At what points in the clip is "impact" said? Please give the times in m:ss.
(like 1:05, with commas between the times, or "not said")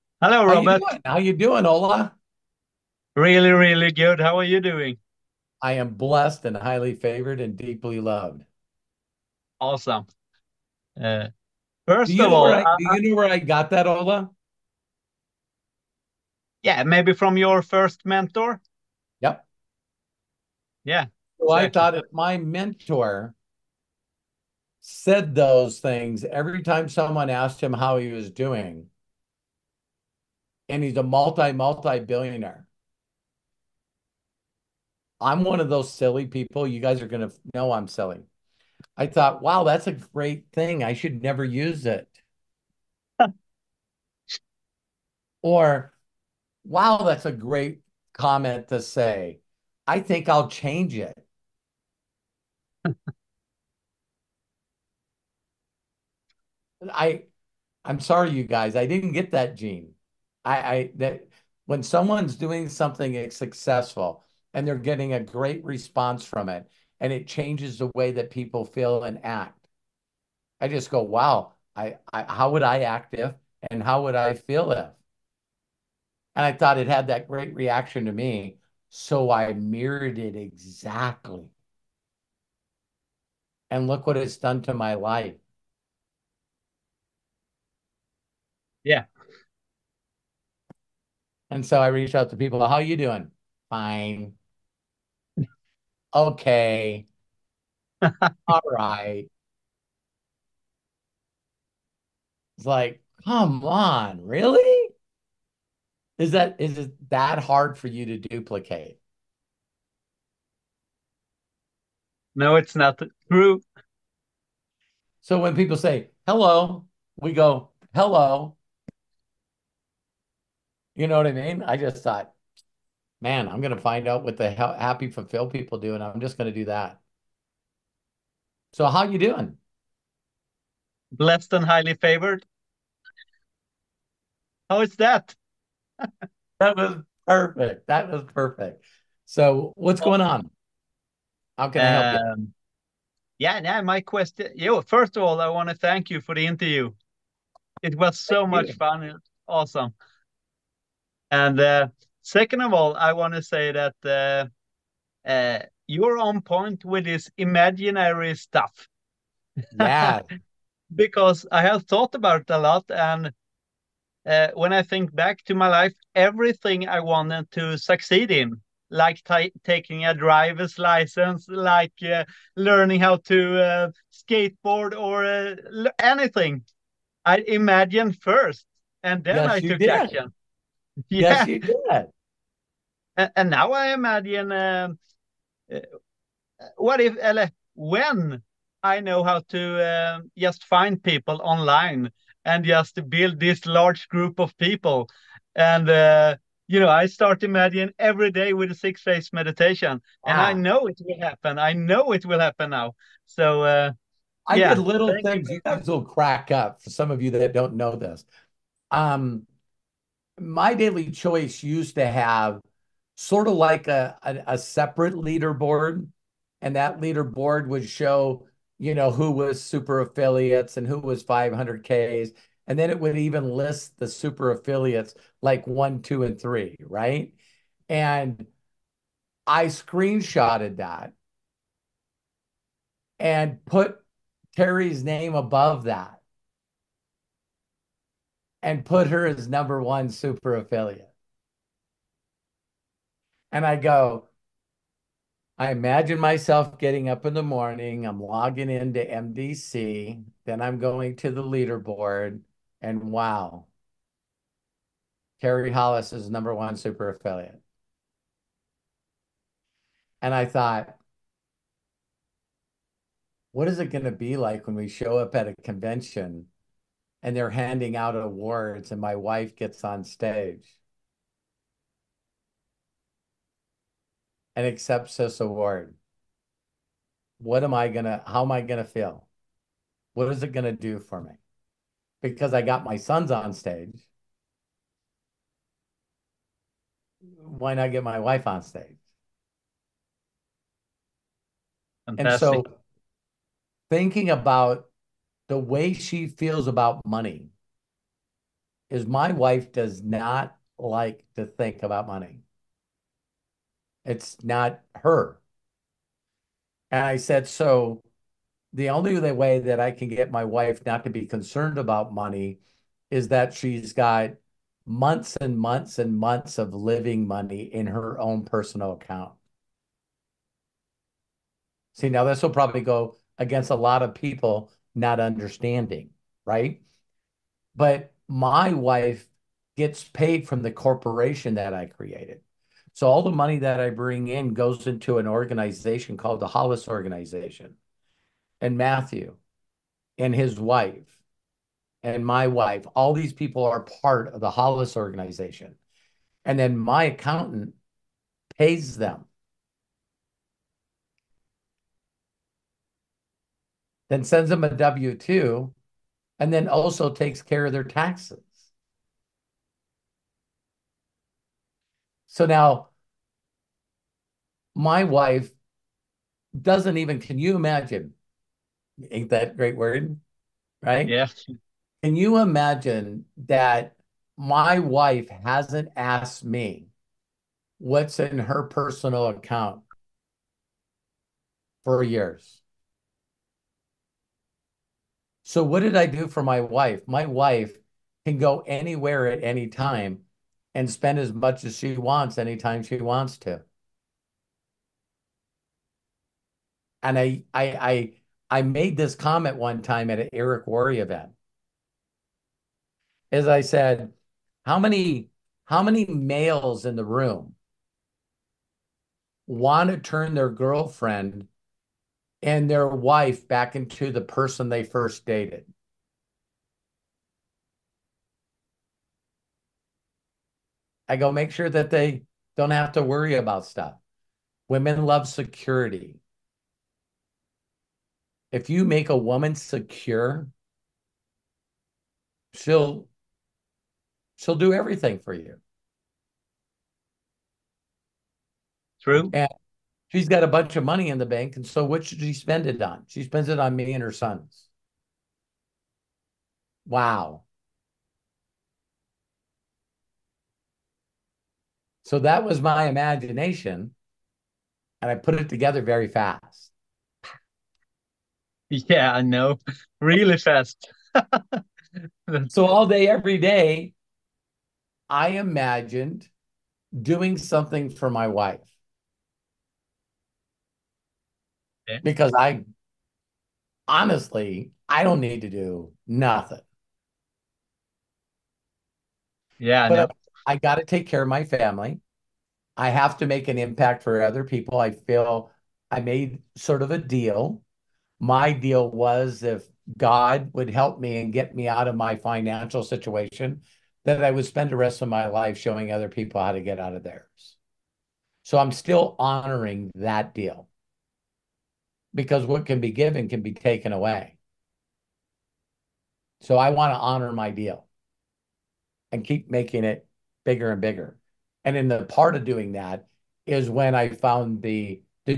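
8:03.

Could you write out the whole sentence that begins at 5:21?
See, now this will probably go against a lot of people not understanding, right?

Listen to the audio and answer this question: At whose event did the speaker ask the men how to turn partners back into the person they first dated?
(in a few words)
Eric Worre.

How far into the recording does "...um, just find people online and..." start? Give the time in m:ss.
3:10.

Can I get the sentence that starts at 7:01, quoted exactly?
I go, make sure that they don't have to worry about stuff.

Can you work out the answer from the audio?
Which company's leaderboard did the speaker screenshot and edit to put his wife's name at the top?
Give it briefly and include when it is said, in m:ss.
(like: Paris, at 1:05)
MyDailyChoice, at 3:30.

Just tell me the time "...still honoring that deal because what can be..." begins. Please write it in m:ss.
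8:18.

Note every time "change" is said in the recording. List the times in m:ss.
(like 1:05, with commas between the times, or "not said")
0:50, 1:07.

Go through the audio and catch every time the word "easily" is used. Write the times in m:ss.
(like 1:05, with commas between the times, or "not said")
not said.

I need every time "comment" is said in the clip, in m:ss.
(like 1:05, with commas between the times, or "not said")
0:48, 6:39.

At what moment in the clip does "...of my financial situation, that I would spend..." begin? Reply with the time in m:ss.
8:11.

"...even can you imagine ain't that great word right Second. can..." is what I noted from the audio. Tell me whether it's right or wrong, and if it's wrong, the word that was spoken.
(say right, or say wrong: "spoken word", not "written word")
wrong: "Yes", not "Second".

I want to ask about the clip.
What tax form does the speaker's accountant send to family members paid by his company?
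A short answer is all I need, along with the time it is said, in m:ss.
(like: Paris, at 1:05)
W-2, at 5:54.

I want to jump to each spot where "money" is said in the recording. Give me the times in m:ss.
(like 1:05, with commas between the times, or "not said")
4:57, 5:02, 5:12, 5:17, 5:33, 7:20.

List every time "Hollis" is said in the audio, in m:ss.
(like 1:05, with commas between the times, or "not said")
4:15, 5:36, 5:44.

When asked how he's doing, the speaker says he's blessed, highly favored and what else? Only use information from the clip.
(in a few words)
Deeply loved.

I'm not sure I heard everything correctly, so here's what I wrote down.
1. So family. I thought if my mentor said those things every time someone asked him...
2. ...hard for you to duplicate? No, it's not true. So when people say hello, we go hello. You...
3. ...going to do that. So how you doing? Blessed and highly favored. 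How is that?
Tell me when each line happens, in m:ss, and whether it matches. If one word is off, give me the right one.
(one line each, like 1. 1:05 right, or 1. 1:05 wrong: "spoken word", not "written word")
1. 0:21 wrong: "exactly", not "family"
2. 1:47 right
3. 2:06 right.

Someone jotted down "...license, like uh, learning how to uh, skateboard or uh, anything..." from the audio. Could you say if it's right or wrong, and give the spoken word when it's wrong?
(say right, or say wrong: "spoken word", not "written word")
right.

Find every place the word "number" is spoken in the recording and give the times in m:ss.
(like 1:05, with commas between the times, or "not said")
3:59, 4:16.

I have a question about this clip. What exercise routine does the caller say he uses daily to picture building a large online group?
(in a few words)
Six phase meditation.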